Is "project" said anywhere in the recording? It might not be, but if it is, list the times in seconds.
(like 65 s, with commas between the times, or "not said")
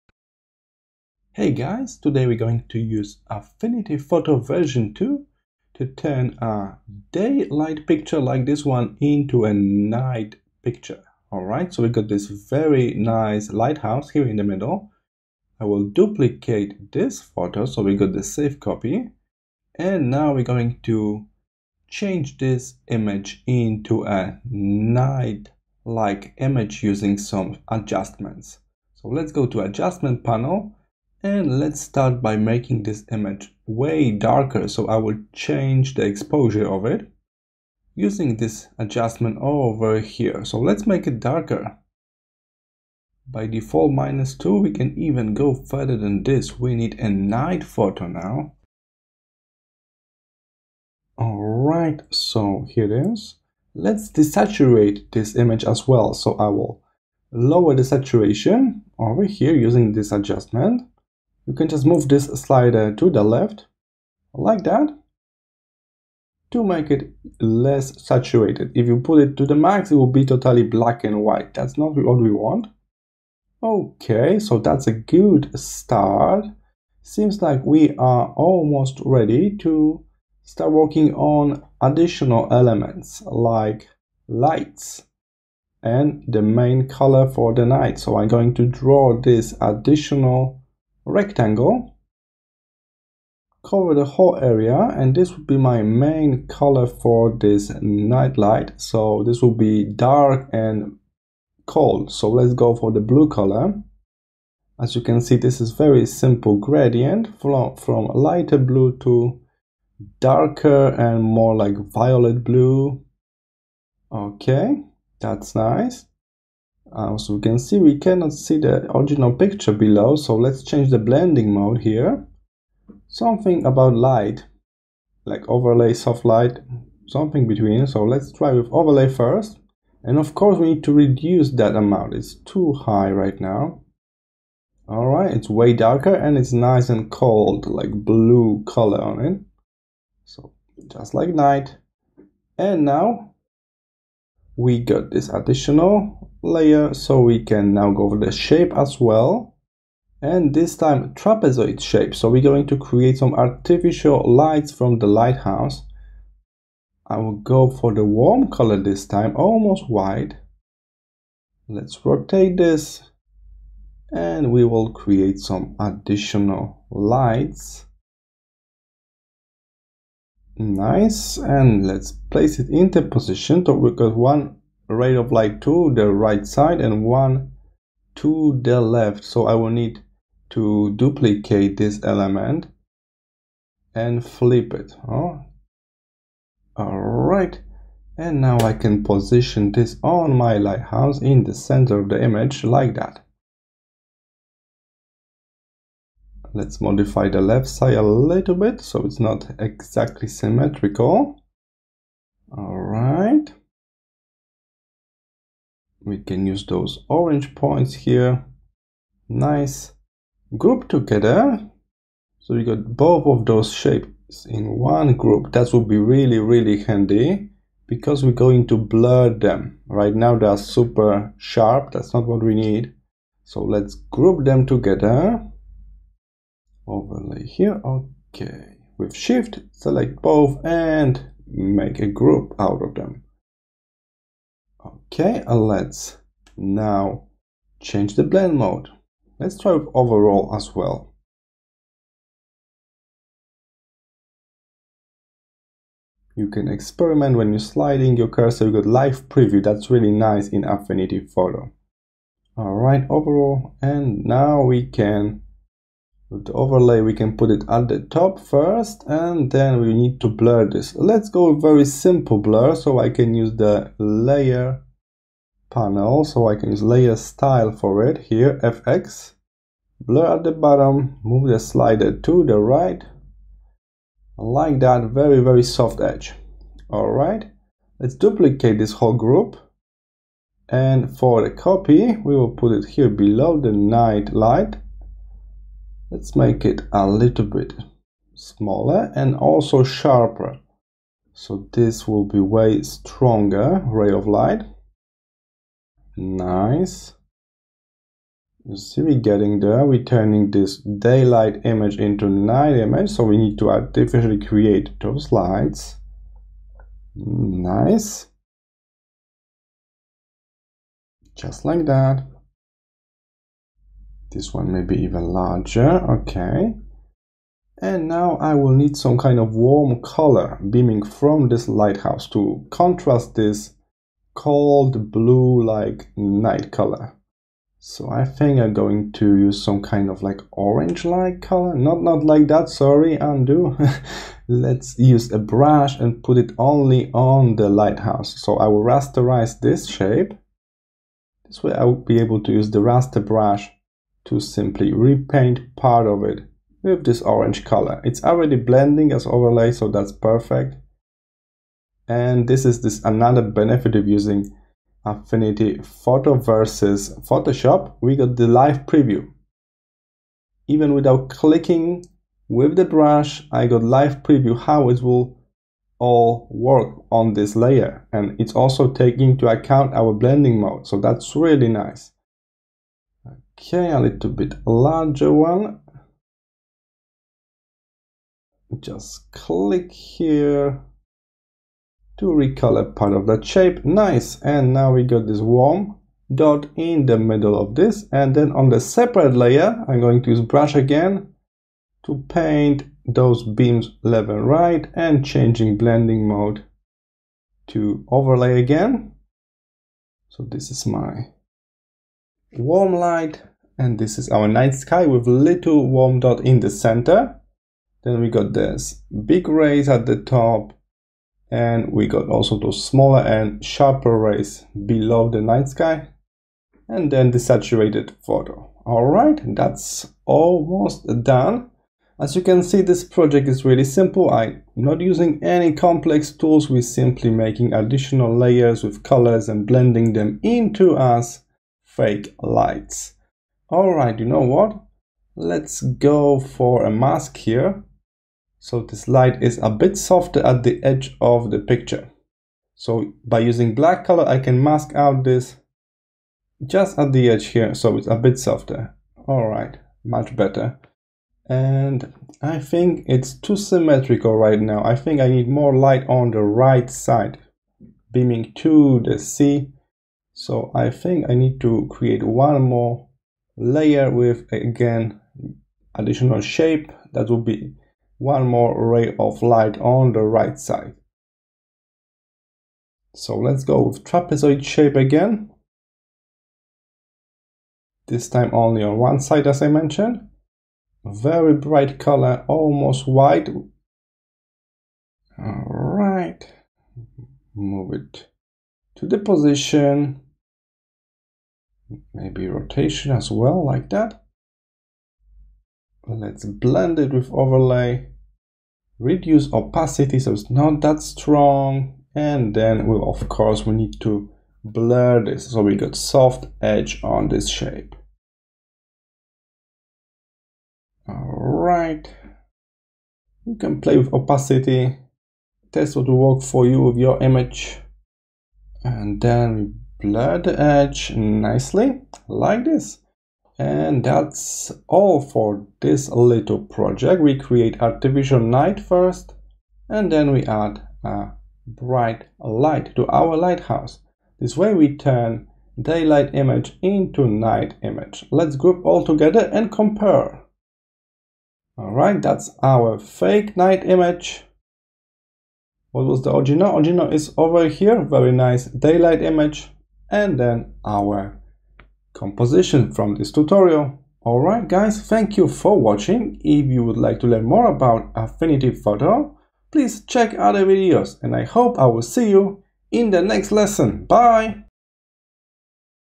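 423 s, 526 s.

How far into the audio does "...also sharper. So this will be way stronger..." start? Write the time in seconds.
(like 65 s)
289 s.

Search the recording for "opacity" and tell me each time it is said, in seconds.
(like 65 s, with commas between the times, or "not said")
499 s, 514 s.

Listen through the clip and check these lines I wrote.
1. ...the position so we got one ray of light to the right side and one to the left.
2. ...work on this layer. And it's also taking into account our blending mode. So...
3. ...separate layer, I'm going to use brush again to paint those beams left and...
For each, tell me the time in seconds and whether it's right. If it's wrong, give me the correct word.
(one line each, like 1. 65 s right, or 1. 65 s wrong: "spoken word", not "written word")
1. 172 s right
2. 366 s right
3. 388 s right.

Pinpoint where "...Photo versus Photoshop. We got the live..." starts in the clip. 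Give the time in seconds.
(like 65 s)
355 s.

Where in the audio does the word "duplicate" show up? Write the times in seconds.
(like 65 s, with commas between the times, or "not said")
15 s, 180 s, 278 s.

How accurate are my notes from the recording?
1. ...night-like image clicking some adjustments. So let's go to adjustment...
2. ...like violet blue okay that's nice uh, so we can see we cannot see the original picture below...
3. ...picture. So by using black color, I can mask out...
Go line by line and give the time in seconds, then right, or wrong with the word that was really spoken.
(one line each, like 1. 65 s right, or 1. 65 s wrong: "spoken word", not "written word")
1. 24 s wrong: "using", not "clicking"
2. 111 s right
3. 441 s right.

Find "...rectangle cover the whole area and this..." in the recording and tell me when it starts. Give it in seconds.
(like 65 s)
91 s.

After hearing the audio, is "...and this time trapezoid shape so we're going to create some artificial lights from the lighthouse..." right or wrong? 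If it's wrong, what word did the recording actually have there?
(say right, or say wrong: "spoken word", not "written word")
right.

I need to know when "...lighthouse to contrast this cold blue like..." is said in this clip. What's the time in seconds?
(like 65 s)
321 s.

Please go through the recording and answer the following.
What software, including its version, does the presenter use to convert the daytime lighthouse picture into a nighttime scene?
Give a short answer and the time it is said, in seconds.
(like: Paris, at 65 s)
Affinity Photo version 2, at 3 s.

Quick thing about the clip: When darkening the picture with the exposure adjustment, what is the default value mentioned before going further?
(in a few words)
-2.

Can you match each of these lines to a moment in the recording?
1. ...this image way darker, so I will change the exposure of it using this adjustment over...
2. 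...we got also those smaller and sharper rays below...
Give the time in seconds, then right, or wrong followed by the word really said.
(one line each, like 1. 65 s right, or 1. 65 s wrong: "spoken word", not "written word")
1. 32 s right
2. 411 s right.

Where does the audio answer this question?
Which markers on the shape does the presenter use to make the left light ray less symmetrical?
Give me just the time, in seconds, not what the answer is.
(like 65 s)
207 s.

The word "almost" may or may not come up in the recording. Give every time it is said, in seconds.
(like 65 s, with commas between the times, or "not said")
78 s, 159 s, 420 s, 482 s.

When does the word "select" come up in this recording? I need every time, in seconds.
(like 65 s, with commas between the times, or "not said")
229 s.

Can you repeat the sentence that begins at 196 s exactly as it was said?
let's modify the left side a little bit so it's not exactly symmetrical.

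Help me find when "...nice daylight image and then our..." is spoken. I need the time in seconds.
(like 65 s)
548 s.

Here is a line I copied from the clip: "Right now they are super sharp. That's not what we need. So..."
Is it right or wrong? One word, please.
right.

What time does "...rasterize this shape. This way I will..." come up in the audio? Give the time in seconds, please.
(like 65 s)
338 s.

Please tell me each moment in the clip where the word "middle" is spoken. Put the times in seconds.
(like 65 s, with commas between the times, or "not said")
14 s, 387 s.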